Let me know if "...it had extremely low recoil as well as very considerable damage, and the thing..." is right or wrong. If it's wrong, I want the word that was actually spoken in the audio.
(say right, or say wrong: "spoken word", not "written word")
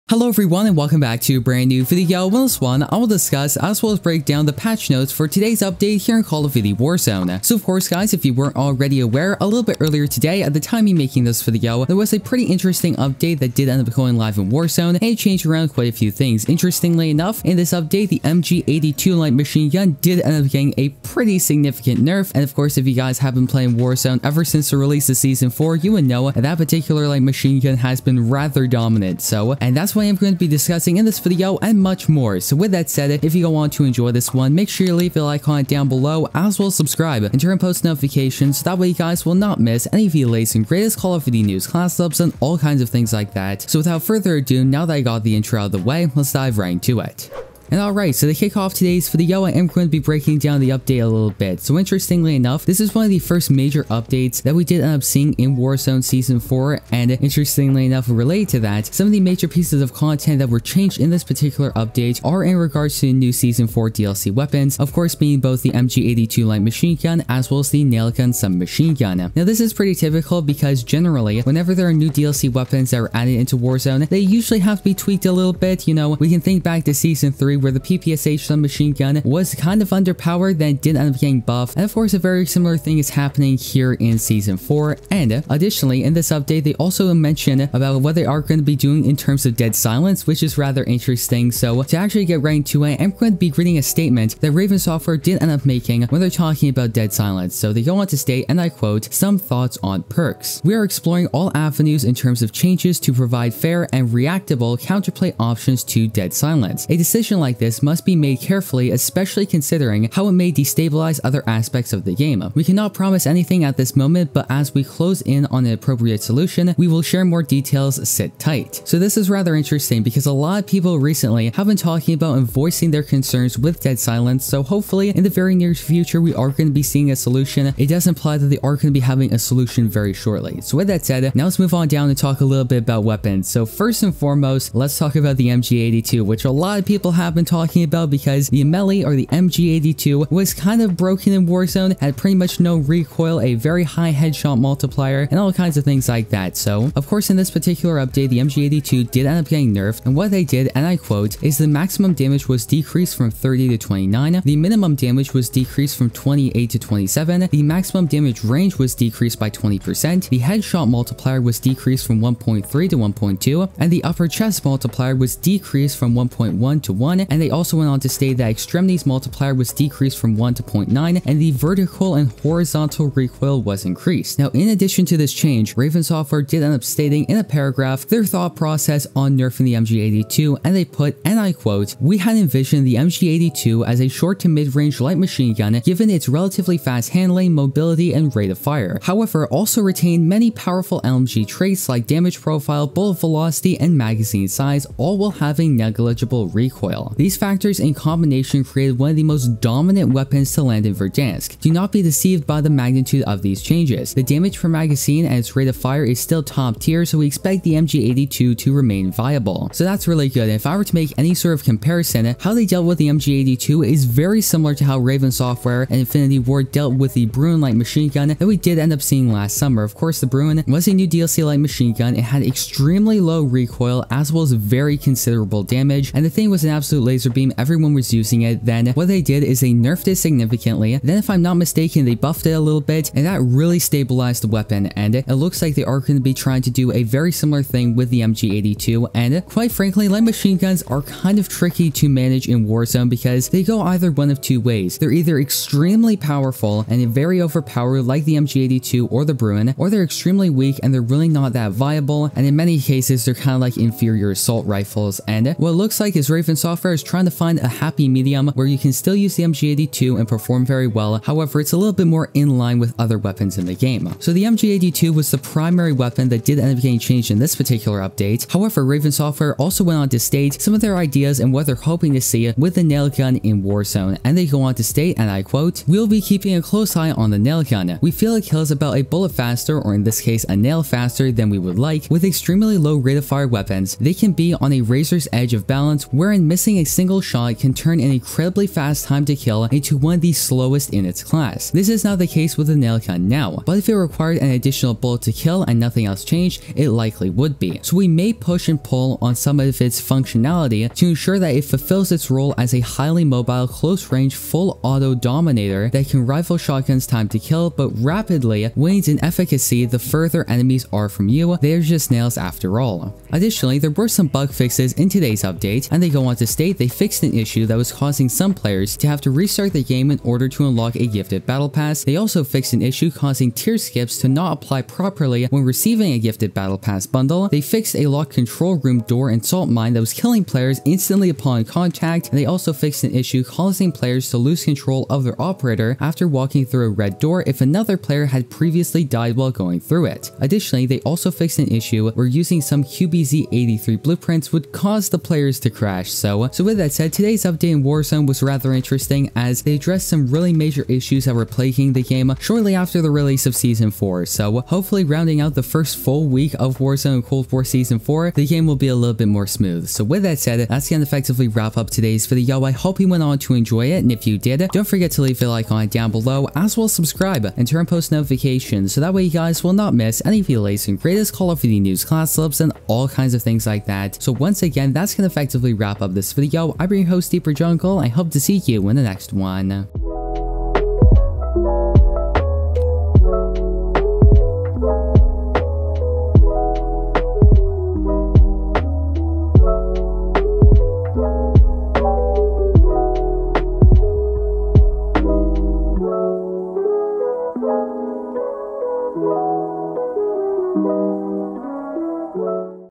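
right.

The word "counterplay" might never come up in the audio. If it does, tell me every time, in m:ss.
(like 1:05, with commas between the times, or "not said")
1:44.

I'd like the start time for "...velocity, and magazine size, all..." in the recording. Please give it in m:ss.
3:13.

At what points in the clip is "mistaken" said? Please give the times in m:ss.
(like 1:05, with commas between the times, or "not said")
3:51.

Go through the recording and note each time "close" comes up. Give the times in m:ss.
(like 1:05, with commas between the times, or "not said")
1:54, 4:36, 5:03.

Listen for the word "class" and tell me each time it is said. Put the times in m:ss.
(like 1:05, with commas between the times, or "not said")
0:41, 4:51, 6:12.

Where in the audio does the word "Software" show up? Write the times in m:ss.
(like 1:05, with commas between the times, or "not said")
1:34, 2:56, 3:35, 4:16, 4:29.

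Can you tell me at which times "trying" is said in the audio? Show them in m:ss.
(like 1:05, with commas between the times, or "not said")
3:56, 4:17.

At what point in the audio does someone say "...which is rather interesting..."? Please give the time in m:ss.
1:30.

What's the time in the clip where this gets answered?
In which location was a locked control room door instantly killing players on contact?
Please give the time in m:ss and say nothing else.
5:29.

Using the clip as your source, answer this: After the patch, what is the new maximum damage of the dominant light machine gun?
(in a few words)
29.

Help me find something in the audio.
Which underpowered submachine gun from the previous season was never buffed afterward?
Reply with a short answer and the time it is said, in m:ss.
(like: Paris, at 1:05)
PPSH, at 1:17.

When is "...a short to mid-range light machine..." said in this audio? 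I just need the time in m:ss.
3:04.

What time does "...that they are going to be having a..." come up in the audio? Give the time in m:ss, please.
2:08.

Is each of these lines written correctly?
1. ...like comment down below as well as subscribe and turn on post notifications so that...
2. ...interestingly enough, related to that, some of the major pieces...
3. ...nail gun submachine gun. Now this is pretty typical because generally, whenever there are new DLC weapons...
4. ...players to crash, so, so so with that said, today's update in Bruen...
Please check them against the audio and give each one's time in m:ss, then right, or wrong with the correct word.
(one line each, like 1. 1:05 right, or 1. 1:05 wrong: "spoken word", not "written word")
1. 0:35 right
2. 0:57 right
3. 1:07 right
4. 5:45 wrong: "Warzone", not "Bruen".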